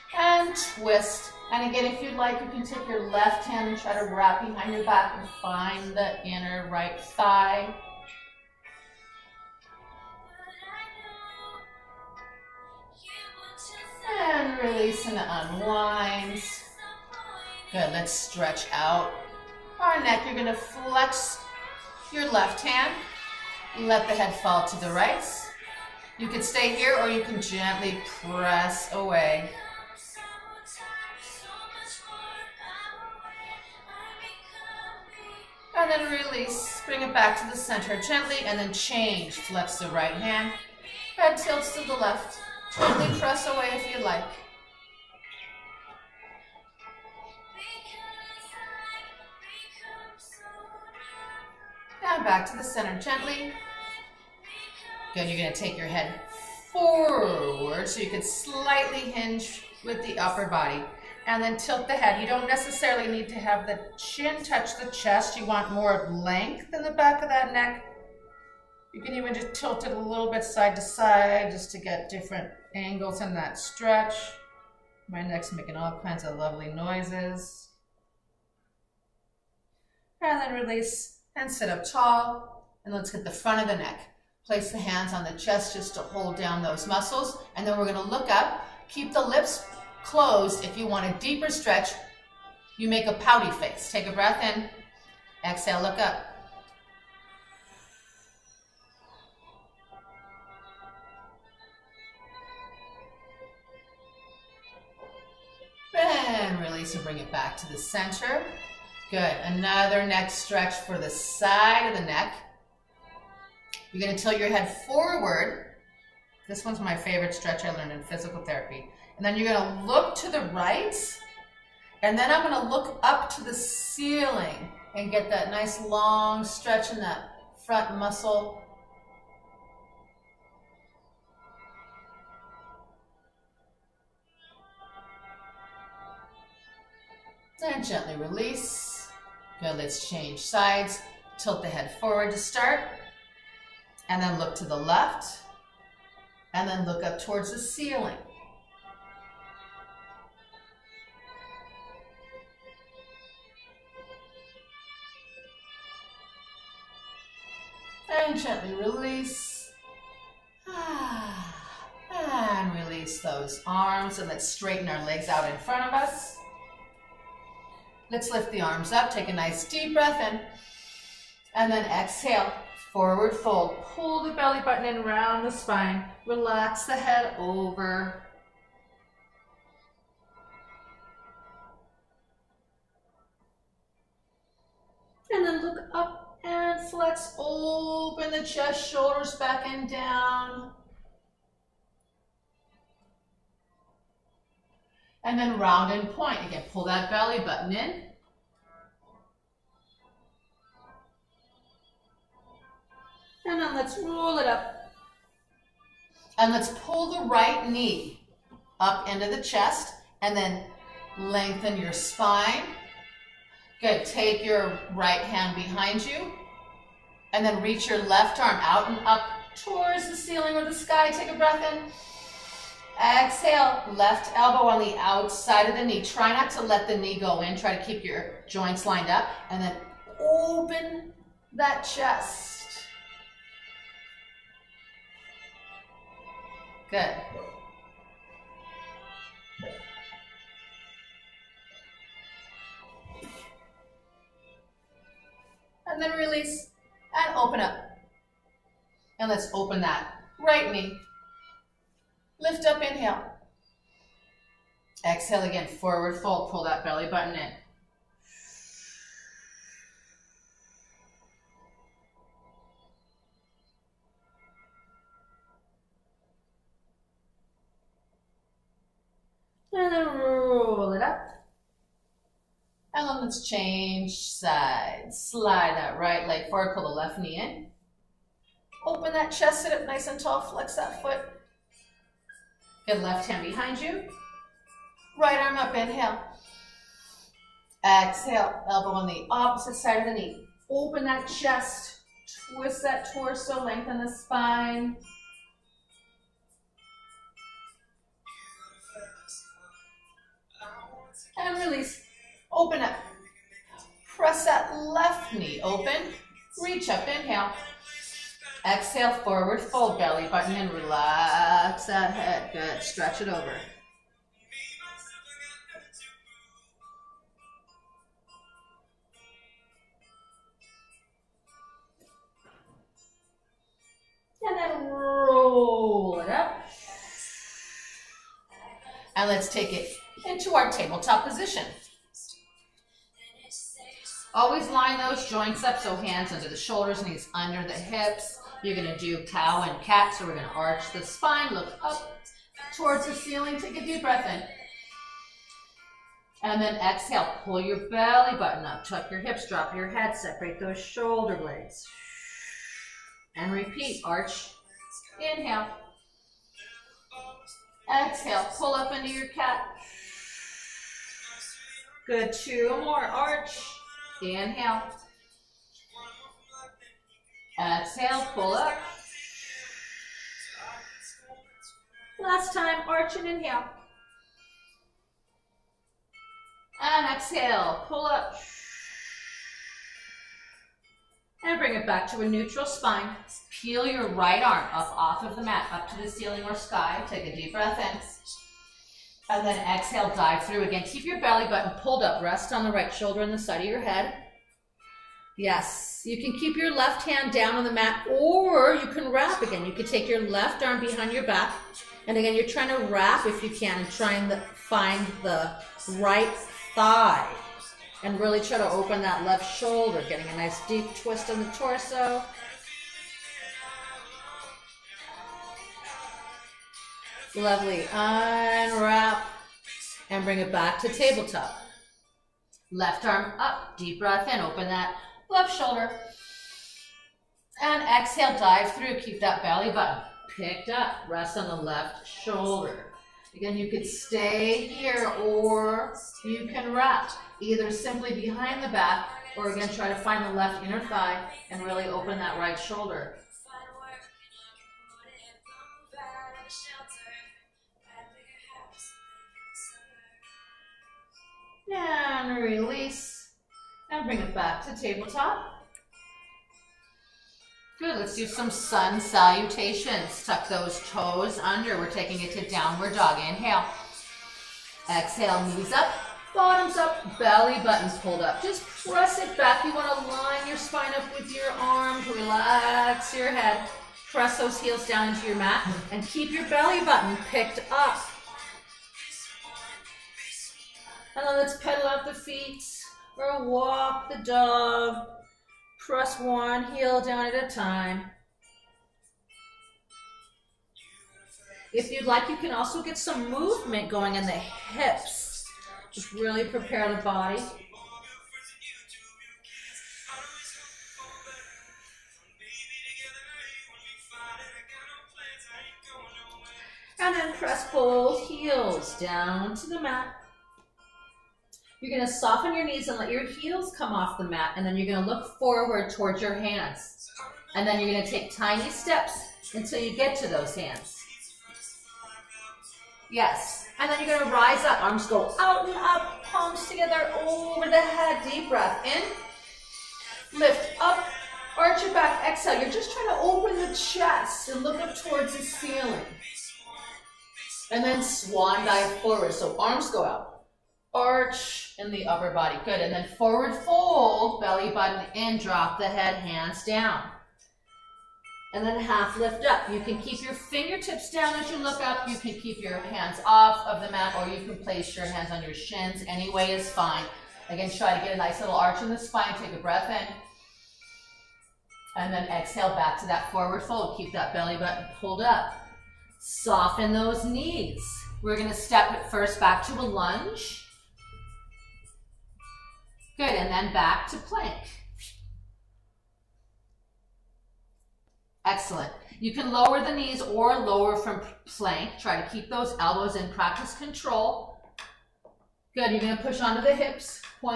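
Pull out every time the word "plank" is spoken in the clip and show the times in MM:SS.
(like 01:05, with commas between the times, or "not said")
09:34, 09:41.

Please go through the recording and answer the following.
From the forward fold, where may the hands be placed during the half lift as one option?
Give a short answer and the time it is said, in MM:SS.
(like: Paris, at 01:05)
On your shins, at 09:15.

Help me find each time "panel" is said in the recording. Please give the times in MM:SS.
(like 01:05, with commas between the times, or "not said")
not said.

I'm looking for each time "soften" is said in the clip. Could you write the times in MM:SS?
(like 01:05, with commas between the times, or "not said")
08:32, 09:26.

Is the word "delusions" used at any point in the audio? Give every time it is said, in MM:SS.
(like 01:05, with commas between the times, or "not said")
not said.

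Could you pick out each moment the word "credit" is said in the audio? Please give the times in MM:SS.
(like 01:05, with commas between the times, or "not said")
not said.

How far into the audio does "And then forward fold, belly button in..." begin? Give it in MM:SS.
09:02.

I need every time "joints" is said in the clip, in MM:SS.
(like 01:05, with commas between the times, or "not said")
03:48, 05:35.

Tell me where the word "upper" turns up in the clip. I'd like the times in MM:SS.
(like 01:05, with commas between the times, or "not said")
01:00, 09:02.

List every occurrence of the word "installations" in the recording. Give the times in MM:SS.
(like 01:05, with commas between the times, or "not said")
not said.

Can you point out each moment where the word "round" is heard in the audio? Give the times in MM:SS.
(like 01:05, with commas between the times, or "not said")
02:55, 03:15.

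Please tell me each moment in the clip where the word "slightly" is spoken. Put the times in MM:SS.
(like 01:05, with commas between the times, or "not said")
00:58.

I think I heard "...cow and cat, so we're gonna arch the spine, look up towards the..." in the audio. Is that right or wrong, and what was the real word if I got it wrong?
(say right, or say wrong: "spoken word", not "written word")
right.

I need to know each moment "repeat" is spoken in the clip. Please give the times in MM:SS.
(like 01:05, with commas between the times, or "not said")
05:53.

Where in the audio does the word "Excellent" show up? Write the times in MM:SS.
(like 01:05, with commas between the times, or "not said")
09:38.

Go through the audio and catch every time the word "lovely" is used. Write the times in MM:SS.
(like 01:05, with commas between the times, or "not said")
01:16, 06:57.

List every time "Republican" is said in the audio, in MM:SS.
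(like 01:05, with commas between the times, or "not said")
not said.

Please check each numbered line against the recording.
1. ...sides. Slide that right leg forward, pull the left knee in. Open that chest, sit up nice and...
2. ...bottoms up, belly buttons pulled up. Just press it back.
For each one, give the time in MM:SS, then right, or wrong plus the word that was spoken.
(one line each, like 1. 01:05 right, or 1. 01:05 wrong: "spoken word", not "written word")
1. 04:34 right
2. 07:46 right.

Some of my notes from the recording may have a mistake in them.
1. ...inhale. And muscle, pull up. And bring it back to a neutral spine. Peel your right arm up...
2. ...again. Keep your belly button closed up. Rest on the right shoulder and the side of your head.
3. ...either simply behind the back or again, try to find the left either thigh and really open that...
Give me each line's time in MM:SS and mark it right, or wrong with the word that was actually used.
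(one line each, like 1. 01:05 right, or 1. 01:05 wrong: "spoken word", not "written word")
1. 06:13 wrong: "exhale", not "muscle"
2. 06:30 wrong: "pulled", not "closed"
3. 07:17 wrong: "inner", not "either".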